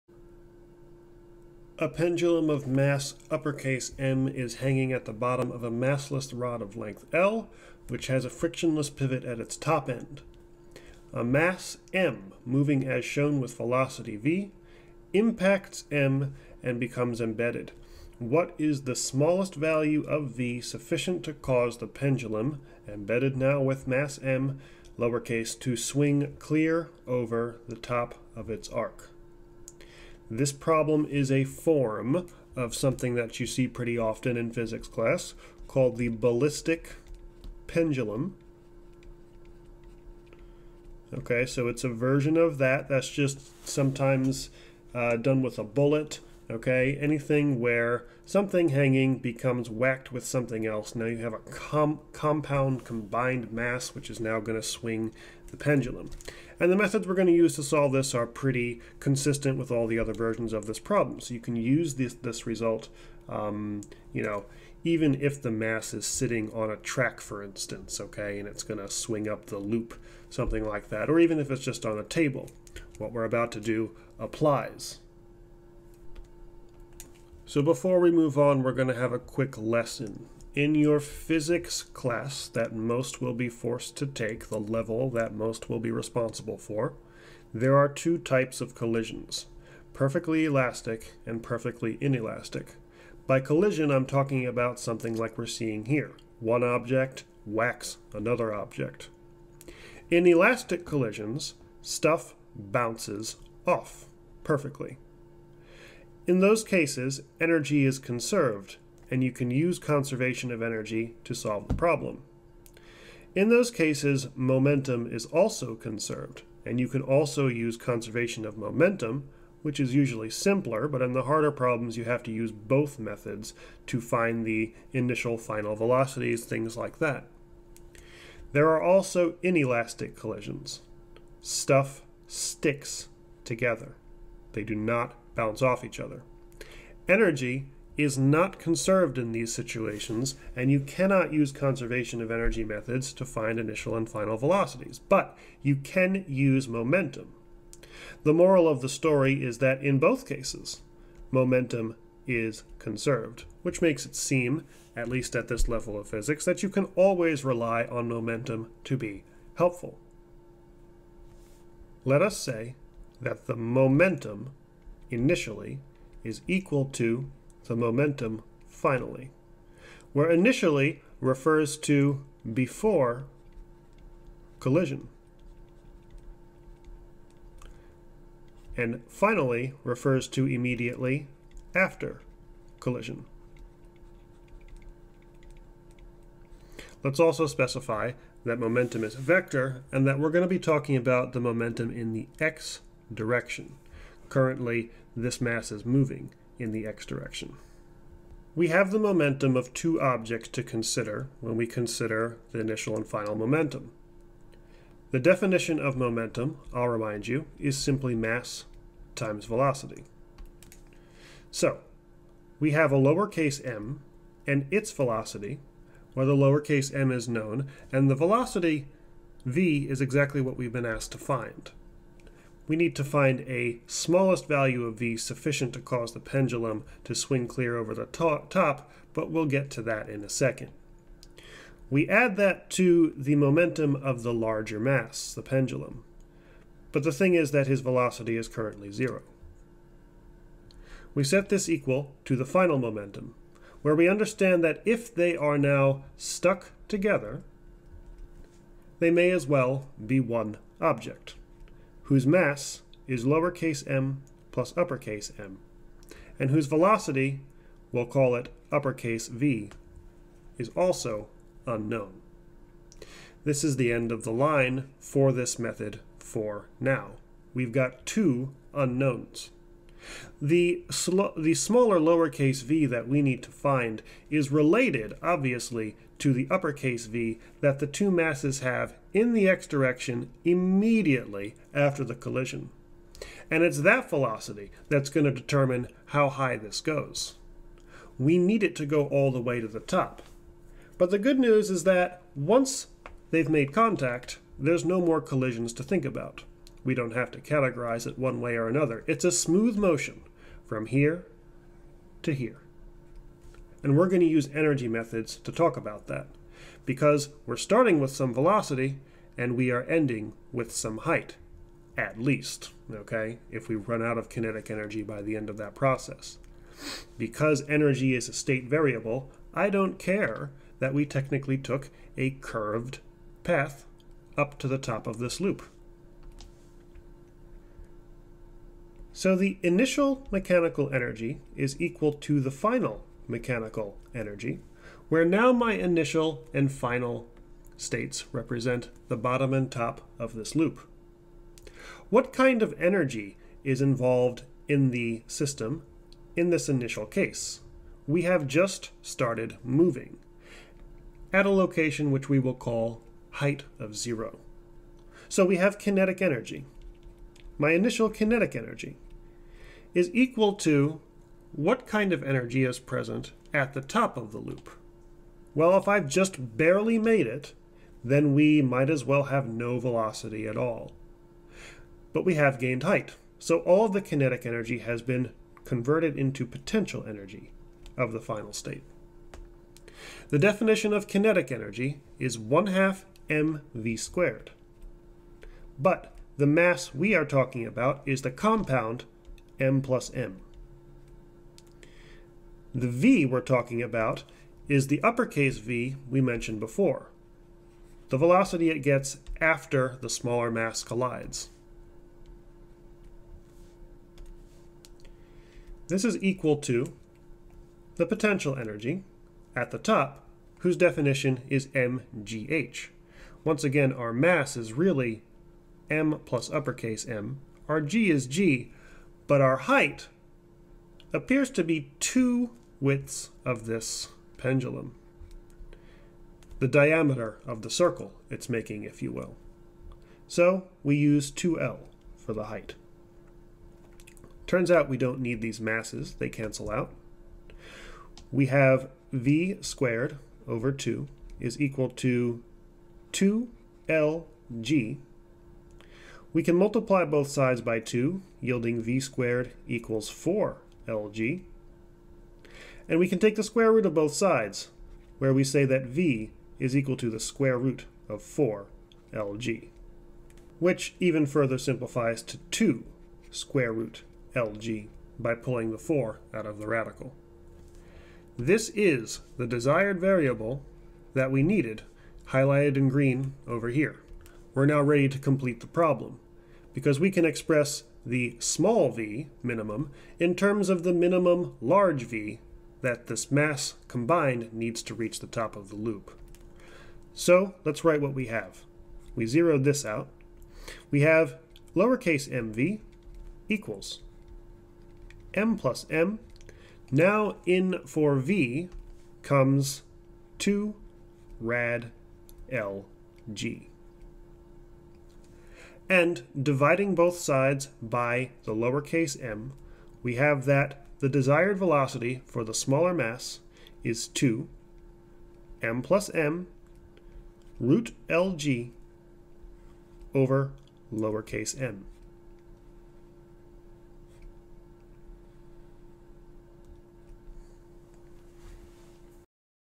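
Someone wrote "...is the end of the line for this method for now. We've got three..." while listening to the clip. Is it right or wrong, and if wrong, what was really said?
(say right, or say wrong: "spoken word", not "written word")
wrong: "two", not "three".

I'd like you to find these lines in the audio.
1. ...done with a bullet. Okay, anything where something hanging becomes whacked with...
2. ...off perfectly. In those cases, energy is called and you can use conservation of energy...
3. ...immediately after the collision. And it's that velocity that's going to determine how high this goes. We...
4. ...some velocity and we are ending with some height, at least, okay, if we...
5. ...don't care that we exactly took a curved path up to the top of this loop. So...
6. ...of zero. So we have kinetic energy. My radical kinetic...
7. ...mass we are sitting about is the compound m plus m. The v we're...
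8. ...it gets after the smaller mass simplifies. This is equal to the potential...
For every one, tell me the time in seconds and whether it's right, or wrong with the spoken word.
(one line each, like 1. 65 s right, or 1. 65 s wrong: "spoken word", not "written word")
1. 45 s right
2. 103 s wrong: "conserved", not "called"
3. 280 s right
4. 308 s right
5. 319 s wrong: "technically", not "exactly"
6. 353 s wrong: "initial", not "radical"
7. 386 s wrong: "talking", not "sitting"
8. 398 s wrong: "collides", not "simplifies".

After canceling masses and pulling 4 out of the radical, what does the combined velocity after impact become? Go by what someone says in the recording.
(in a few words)
2 square root LG.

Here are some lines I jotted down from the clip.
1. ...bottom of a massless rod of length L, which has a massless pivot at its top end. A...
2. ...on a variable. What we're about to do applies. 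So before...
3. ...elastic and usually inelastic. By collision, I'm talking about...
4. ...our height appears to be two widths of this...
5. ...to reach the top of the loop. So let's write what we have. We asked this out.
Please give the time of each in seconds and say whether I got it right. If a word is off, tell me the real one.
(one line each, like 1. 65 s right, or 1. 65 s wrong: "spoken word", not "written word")
1. 5 s wrong: "frictionless", not "massless"
2. 71 s wrong: "table", not "variable"
3. 90 s wrong: "perfectly", not "usually"
4. 419 s right
5. 484 s wrong: "zeroed", not "asked".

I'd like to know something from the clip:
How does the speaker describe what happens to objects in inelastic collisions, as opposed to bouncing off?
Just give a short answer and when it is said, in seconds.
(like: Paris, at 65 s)
stuff sticks together, at 131 s.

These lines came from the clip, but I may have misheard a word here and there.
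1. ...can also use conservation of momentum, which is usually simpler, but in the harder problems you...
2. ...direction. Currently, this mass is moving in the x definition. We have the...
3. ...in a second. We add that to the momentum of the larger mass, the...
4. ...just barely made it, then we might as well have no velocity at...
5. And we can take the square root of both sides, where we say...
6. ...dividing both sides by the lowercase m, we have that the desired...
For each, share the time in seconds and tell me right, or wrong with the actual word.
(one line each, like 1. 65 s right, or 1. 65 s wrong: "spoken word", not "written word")
1. 116 s right
2. 193 s wrong: "direction", not "definition"
3. 230 s right
4. 366 s right
5. 452 s right
6. 506 s right.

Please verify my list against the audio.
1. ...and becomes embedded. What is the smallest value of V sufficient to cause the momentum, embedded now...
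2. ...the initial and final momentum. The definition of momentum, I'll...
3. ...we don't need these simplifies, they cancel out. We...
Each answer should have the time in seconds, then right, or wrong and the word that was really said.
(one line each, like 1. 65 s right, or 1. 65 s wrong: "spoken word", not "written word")
1. 16 s wrong: "pendulum", not "momentum"
2. 202 s right
3. 434 s wrong: "masses", not "simplifies".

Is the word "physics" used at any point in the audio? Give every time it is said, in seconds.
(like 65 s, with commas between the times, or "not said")
34 s, 80 s, 156 s.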